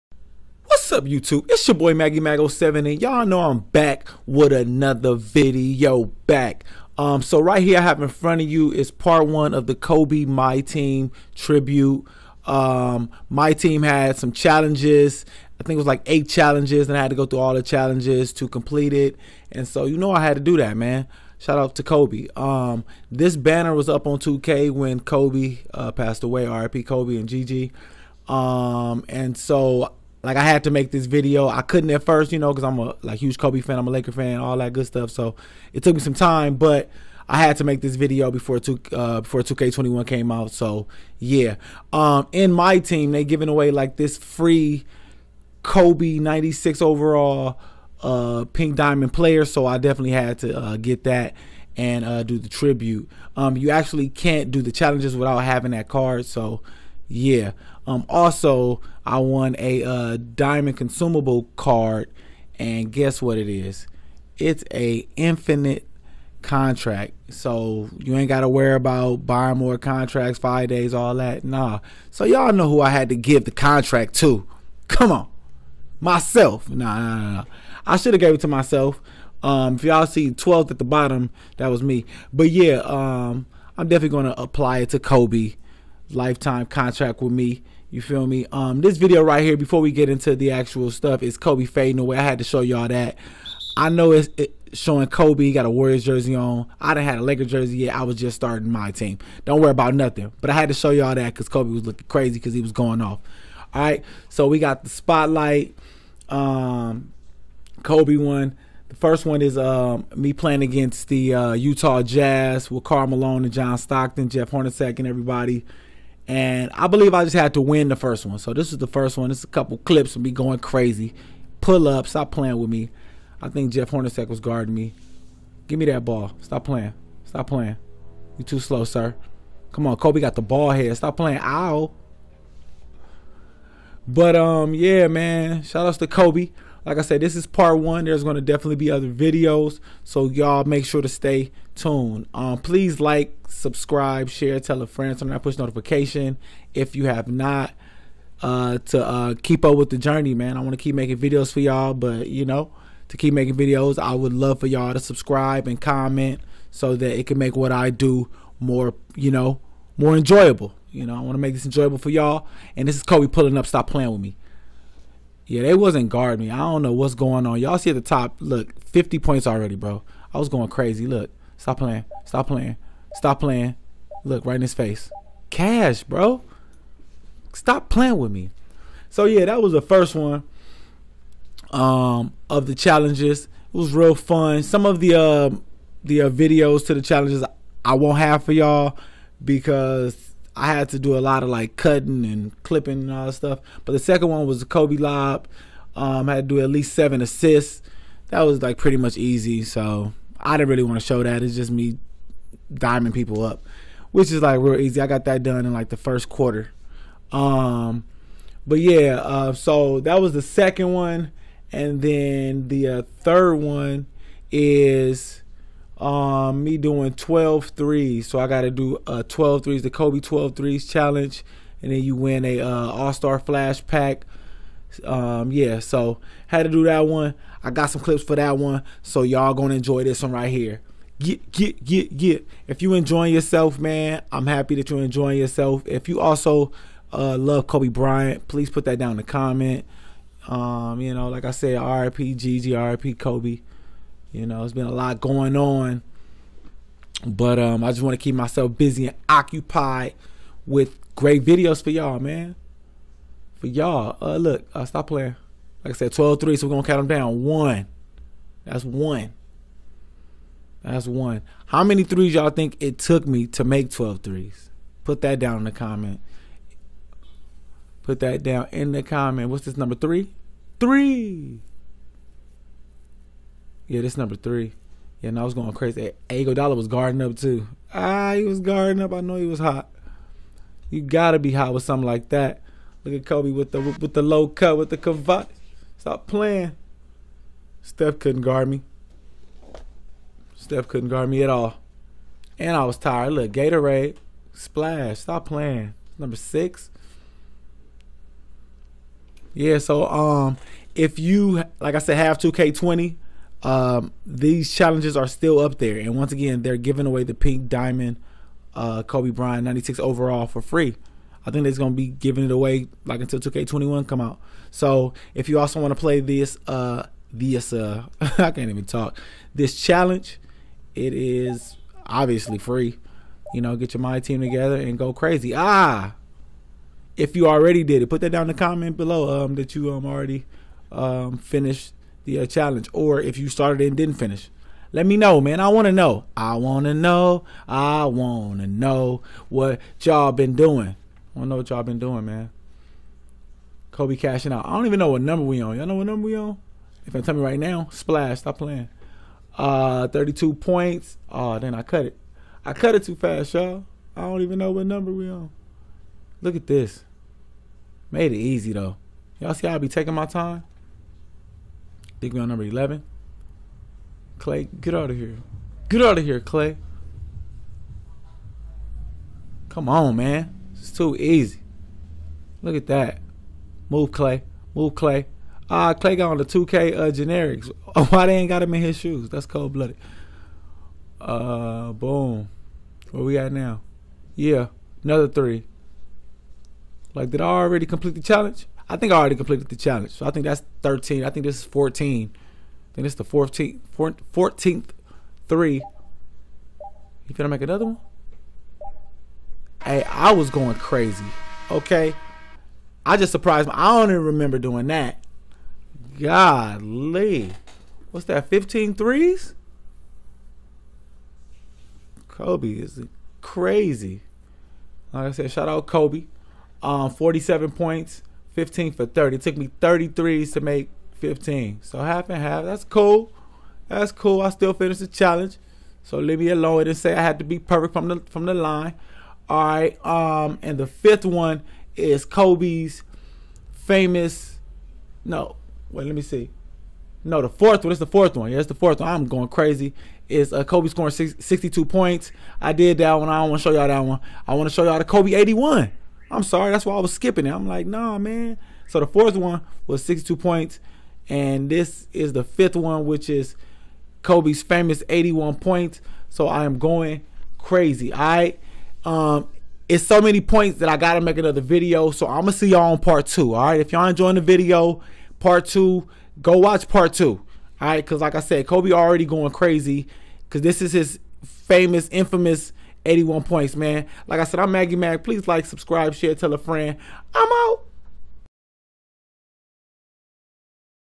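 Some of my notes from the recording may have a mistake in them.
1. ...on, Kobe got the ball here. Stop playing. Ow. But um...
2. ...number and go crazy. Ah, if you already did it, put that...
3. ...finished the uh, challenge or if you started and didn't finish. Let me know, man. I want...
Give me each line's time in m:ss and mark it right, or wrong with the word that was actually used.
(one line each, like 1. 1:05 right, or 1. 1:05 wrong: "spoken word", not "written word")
1. 2:09 right
2. 5:24 wrong: "together", not "number"
3. 5:31 right.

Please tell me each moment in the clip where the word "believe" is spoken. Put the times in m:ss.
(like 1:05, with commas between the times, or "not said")
1:56.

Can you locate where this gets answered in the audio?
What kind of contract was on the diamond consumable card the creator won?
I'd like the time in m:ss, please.
1:05.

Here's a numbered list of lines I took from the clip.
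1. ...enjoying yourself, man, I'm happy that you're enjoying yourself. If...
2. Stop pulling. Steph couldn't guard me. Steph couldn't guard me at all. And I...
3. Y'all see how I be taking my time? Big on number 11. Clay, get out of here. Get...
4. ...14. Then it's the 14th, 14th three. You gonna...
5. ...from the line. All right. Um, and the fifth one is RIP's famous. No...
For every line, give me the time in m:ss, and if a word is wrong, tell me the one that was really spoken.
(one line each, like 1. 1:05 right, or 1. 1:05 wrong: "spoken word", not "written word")
1. 3:52 right
2. 4:45 wrong: "playing", not "pulling"
3. 5:59 right
4. 6:31 right
5. 7:08 wrong: "Kobe", not "RIP".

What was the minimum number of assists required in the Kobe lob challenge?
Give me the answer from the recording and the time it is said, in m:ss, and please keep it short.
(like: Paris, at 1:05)
7, at 3:16.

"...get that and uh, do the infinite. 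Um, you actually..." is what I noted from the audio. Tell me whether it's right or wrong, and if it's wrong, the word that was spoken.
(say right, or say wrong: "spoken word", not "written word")
wrong: "tribute", not "infinite".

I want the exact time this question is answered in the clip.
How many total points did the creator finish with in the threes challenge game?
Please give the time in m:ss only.
6:57.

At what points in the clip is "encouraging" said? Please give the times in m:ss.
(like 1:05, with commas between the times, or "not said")
not said.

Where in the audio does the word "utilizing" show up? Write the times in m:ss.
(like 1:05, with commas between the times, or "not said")
not said.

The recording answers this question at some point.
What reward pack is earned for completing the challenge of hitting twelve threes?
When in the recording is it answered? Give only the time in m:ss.
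3:42.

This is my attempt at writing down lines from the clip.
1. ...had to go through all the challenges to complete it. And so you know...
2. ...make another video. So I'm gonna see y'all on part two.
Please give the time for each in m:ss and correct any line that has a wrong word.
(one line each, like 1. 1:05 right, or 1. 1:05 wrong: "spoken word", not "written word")
1. 0:17 right
2. 7:41 right.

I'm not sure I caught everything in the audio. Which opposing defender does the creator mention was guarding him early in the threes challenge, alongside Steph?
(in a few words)
Iguodala.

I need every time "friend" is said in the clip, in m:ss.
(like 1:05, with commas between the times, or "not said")
2:24, 7:56.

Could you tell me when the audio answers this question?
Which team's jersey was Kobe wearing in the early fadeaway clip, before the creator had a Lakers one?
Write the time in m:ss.
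1:35.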